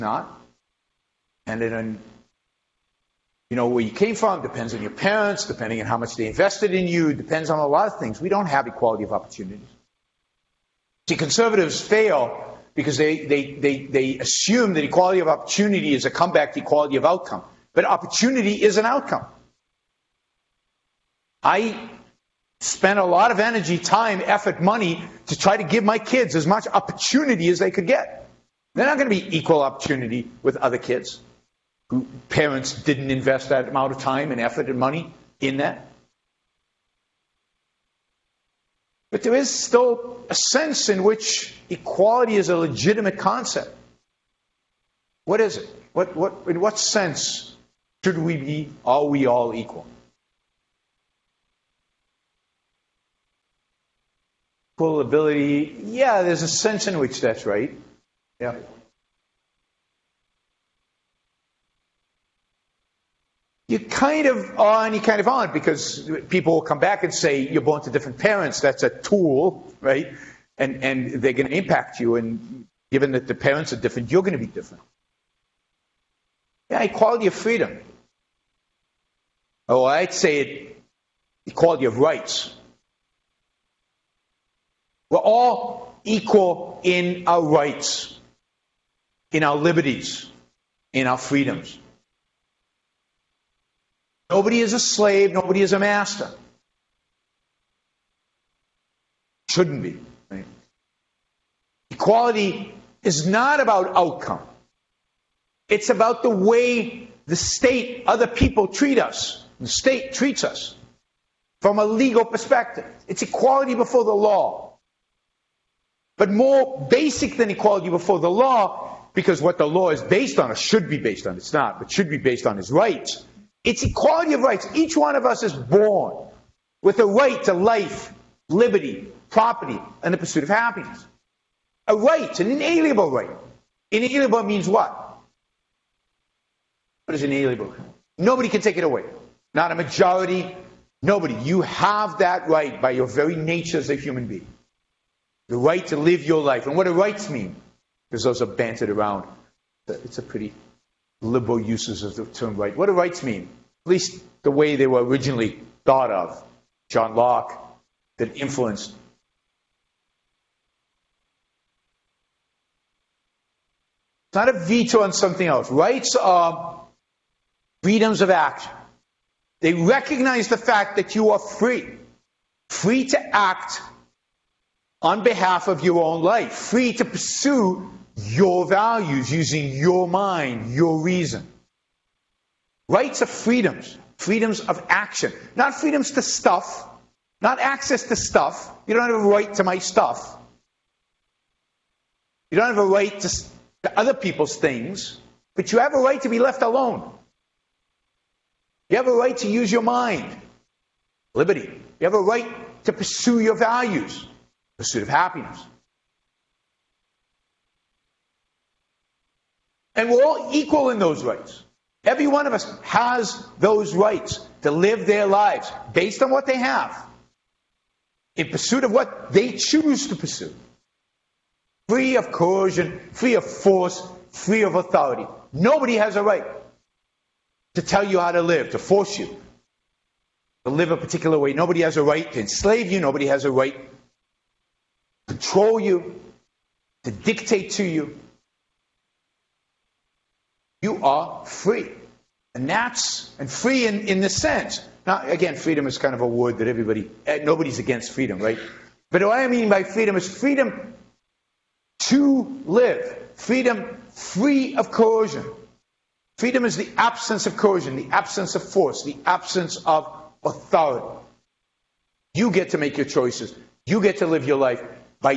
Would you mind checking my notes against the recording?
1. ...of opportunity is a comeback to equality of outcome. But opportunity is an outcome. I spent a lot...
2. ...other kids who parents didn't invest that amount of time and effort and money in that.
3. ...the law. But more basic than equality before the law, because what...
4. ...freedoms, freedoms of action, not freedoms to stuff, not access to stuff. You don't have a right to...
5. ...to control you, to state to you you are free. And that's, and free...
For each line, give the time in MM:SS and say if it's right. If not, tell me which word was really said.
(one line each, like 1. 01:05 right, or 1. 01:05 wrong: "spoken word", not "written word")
1. 00:15 right
2. 00:30 right
3. 01:54 right
4. 03:03 right
5. 03:55 wrong: "dictate", not "state".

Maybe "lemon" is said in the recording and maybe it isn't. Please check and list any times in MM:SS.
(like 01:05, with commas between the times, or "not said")
not said.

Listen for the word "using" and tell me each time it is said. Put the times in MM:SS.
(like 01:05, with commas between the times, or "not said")
02:59.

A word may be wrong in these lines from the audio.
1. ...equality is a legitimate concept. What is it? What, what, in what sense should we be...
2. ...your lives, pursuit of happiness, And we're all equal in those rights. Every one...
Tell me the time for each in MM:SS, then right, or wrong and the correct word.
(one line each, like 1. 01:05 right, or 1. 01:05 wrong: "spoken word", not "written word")
1. 00:41 right
2. 03:23 wrong: "values", not "lives".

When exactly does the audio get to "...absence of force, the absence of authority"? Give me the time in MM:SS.
04:18.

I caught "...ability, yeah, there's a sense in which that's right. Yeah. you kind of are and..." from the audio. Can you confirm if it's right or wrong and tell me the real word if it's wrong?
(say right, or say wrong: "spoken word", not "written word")
right.